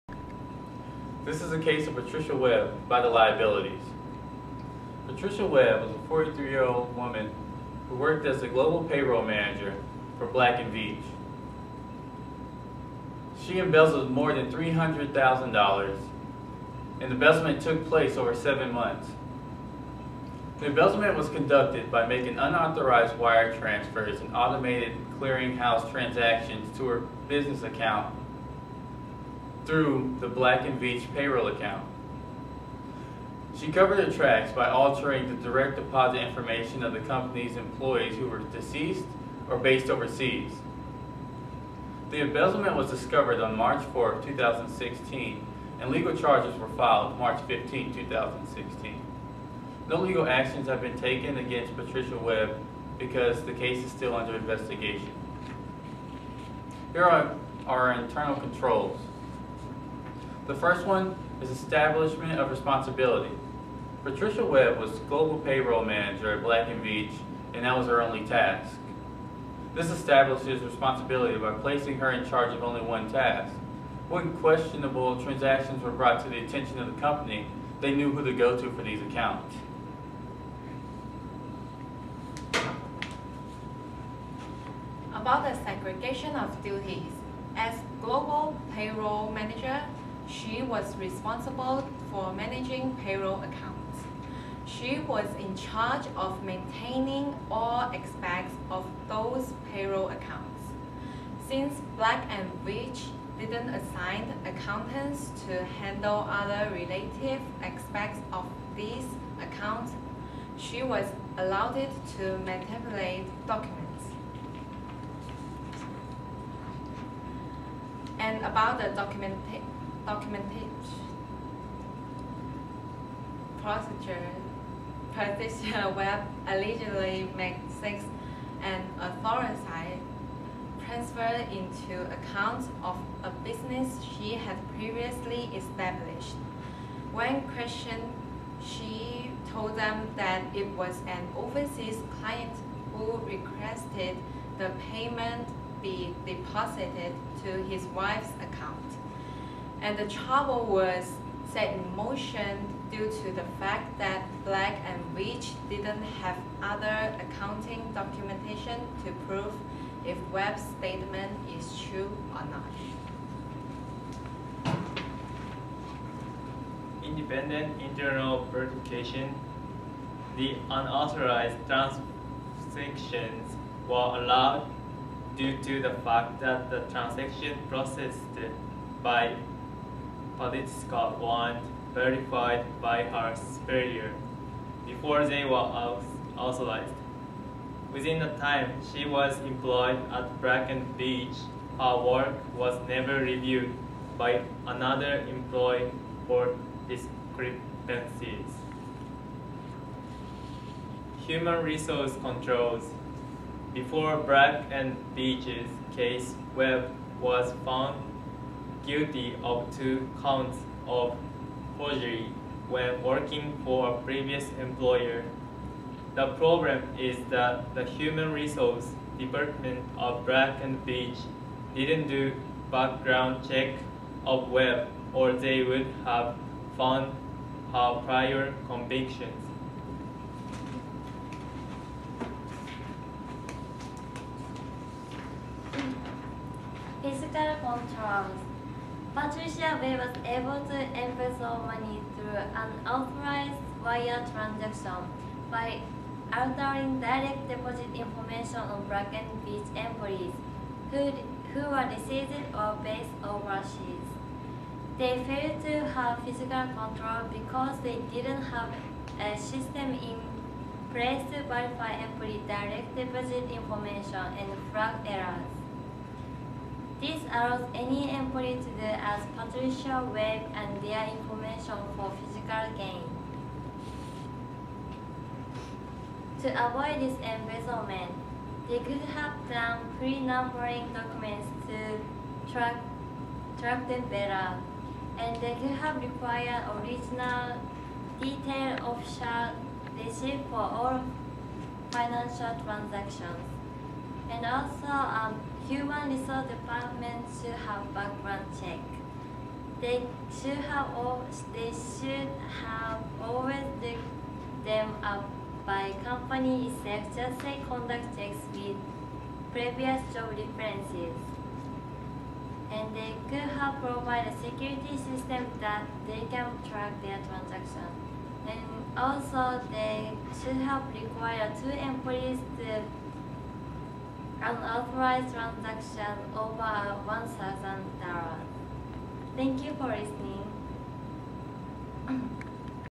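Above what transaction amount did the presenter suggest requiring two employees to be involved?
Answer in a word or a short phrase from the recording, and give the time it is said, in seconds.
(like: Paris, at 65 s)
$1,000, at 327 s.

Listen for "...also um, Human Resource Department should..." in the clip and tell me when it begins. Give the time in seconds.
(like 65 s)
294 s.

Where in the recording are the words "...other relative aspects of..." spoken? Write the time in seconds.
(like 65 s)
106 s.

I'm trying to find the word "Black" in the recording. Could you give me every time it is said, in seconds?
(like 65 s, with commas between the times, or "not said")
10 s, 30 s, 66 s, 101 s, 154 s, 220 s.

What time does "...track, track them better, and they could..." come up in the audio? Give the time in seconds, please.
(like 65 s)
282 s.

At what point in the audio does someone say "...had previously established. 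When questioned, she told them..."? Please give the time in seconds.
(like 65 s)
134 s.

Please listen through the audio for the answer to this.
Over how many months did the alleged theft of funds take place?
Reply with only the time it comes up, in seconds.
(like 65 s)
18 s.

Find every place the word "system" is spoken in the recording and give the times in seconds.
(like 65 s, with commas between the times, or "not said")
259 s, 314 s.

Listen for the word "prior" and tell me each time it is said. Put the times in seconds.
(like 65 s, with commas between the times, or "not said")
228 s.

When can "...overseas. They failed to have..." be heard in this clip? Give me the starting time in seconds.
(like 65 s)
253 s.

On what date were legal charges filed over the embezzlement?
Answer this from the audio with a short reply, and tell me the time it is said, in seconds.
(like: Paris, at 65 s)
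March 15, 2016, at 47 s.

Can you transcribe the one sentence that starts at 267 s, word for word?
This allows any employee to do as Patricia Webb and their information for physical gain.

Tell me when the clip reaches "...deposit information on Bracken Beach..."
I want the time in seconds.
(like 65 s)
247 s.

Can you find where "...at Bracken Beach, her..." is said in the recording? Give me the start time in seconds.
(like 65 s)
190 s.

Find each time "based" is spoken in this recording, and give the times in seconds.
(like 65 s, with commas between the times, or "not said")
39 s, 252 s.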